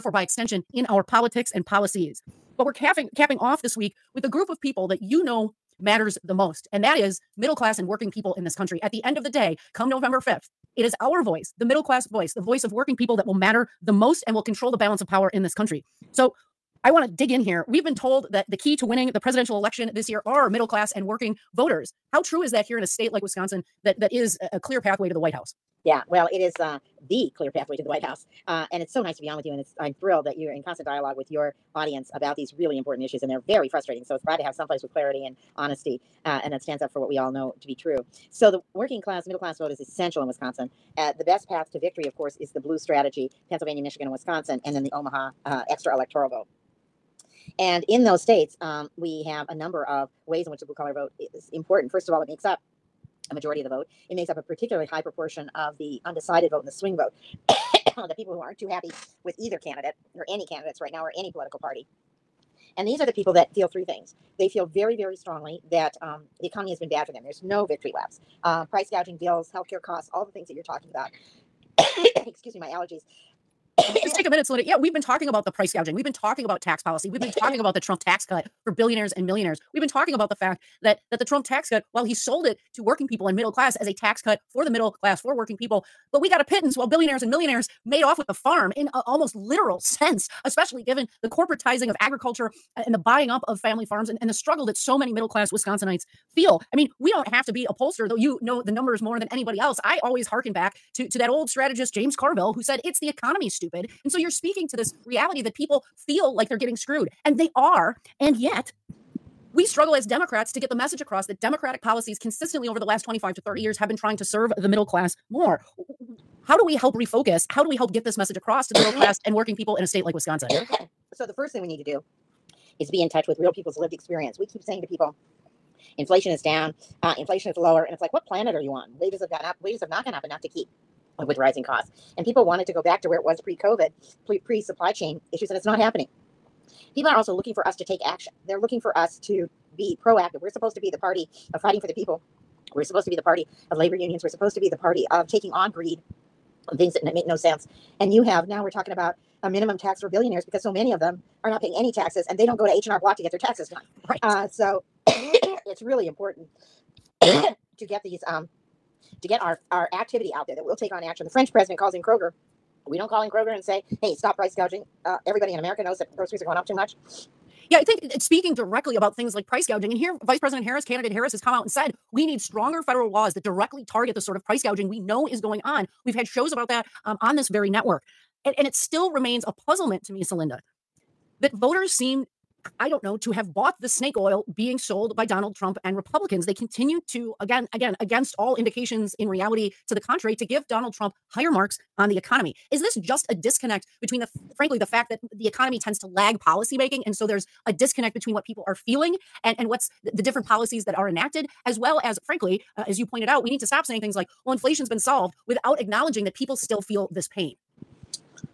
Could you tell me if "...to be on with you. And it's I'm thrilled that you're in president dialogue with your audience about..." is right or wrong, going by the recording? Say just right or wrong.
wrong.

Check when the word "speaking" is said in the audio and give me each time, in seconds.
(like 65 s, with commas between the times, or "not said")
104 s, 168 s.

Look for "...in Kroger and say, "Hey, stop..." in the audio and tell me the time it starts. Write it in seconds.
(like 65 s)
163 s.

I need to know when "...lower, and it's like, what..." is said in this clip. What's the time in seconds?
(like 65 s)
127 s.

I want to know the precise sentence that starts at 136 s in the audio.
People are also looking for us to take action.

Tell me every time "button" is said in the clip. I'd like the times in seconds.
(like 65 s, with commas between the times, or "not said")
not said.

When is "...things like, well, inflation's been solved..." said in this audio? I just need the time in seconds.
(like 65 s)
204 s.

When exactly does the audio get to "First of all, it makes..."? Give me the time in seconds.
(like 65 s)
51 s.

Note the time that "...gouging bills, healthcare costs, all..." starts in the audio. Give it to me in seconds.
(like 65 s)
68 s.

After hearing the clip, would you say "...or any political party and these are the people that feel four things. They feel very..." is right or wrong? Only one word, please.
wrong.